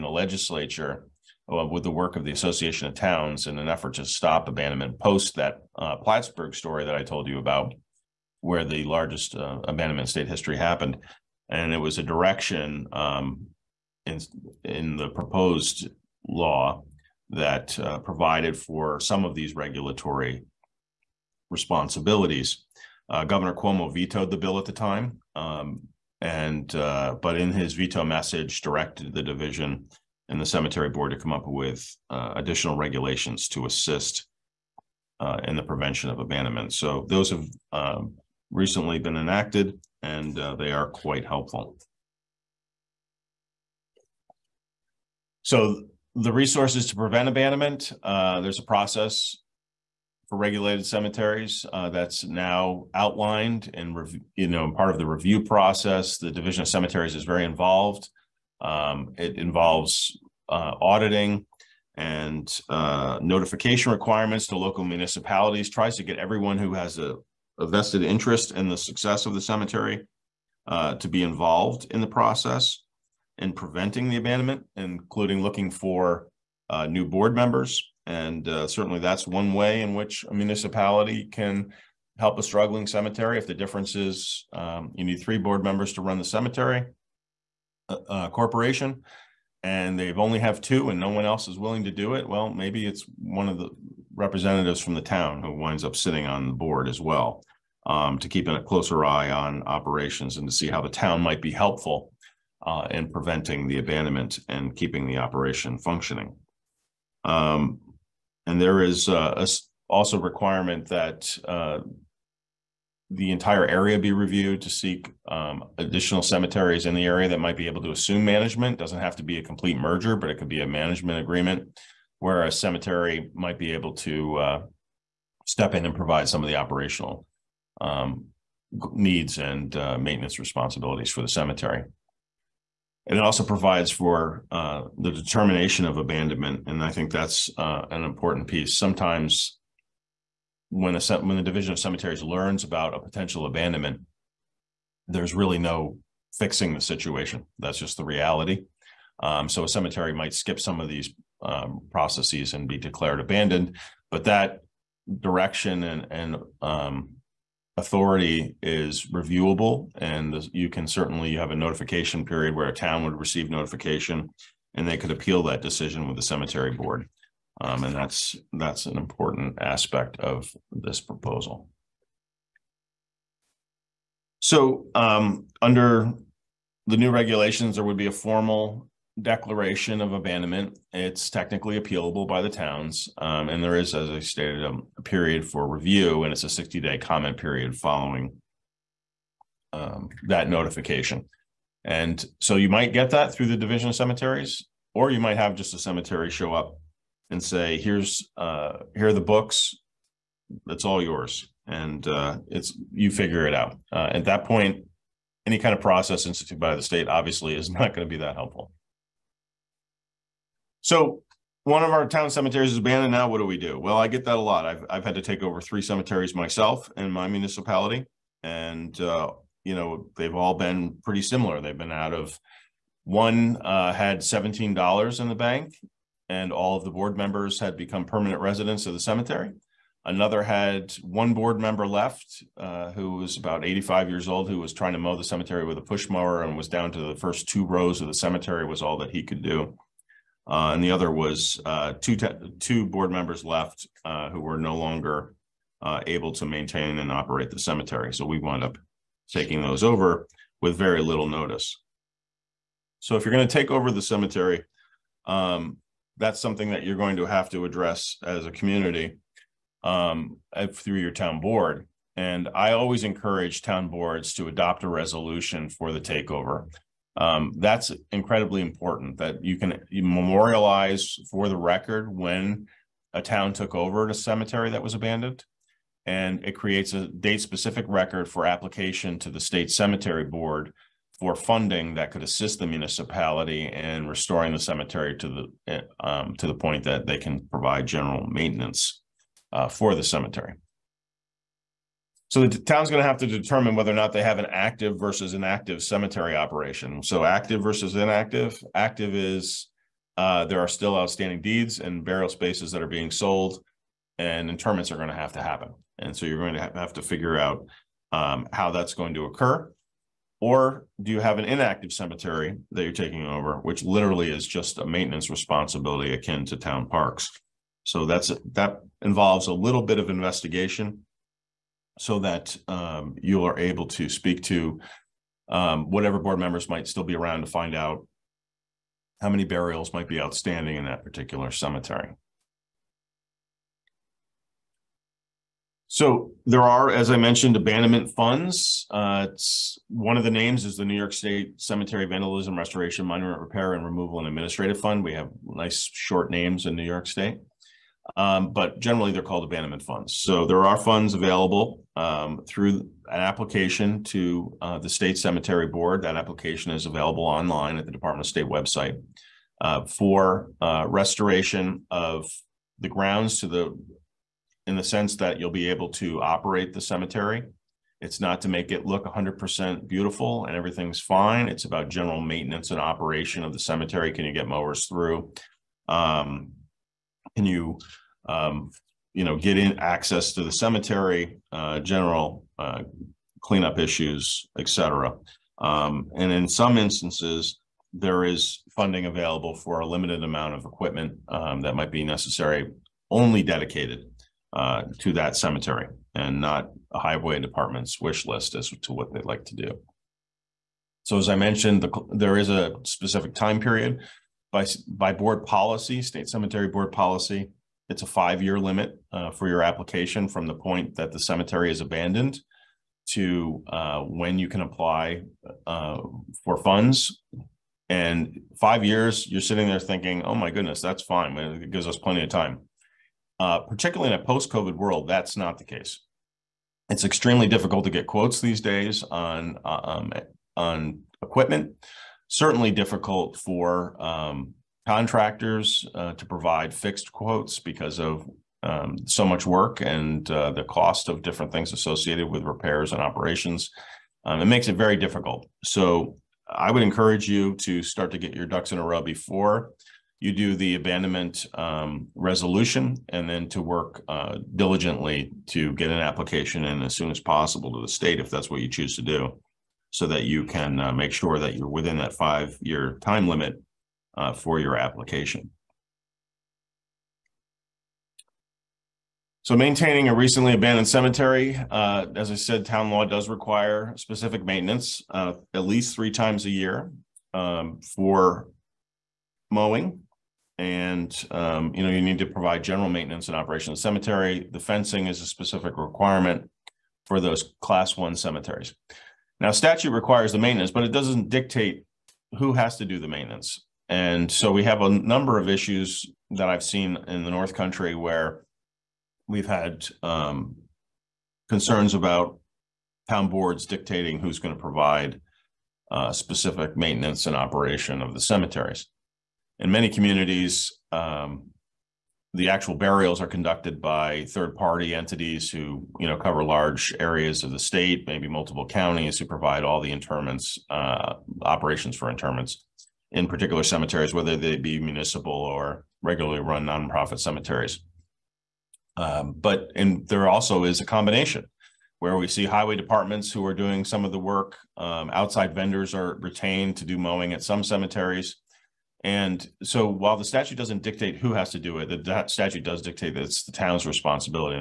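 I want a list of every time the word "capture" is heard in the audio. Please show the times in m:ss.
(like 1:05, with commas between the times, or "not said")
not said.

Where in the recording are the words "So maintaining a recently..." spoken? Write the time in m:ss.
7:49.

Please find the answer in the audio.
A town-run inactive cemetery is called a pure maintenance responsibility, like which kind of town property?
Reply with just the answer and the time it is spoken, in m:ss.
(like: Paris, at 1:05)
town parks, at 5:16.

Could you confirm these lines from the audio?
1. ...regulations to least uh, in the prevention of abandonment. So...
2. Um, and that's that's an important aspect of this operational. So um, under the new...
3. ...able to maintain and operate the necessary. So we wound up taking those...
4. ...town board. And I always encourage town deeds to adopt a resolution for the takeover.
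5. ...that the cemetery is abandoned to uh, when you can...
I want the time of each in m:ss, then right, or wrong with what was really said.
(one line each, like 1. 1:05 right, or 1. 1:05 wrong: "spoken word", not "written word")
1. 0:32 wrong: "assist", not "least"
2. 2:47 wrong: "proposal", not "operational"
3. 4:06 wrong: "cemetery", not "necessary"
4. 4:21 wrong: "boards", not "deeds"
5. 6:50 right.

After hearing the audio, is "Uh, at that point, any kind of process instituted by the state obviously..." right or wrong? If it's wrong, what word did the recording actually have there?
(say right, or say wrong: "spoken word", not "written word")
right.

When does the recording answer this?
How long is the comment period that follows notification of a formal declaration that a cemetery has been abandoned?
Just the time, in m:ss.
3:06.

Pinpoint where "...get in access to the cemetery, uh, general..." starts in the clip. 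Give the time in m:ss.
6:19.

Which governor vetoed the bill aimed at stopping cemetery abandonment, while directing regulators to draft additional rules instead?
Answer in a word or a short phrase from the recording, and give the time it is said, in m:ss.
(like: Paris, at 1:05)
Cuomo, at 0:23.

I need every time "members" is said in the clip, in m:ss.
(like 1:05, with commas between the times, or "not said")
1:17, 1:25, 3:47, 3:51, 4:03, 5:26.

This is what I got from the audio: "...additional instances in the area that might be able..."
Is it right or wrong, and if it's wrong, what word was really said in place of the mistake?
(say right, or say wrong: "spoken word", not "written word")
wrong: "cemeteries", not "instances".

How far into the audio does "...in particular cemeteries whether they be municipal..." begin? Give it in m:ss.
8:43.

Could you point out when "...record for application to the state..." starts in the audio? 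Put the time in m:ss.
4:37.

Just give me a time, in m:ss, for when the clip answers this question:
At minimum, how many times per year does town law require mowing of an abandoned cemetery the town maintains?
7:55.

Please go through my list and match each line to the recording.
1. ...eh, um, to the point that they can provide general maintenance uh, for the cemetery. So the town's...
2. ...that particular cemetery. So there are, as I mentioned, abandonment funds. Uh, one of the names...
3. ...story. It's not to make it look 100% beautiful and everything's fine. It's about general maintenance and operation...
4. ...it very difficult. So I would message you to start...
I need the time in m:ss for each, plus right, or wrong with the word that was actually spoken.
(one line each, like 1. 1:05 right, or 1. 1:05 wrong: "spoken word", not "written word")
1. 4:45 right
2. 5:30 right
3. 6:06 wrong: "cemetery", not "story"
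4. 7:24 wrong: "encourage", not "message".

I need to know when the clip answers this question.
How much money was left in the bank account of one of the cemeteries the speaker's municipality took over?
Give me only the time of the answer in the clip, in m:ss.
3:44.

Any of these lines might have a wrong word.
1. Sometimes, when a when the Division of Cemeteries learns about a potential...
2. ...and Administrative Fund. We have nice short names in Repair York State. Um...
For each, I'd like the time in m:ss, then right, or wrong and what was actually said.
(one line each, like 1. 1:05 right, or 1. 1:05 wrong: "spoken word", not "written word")
1. 2:18 right
2. 5:44 wrong: "New", not "Repair".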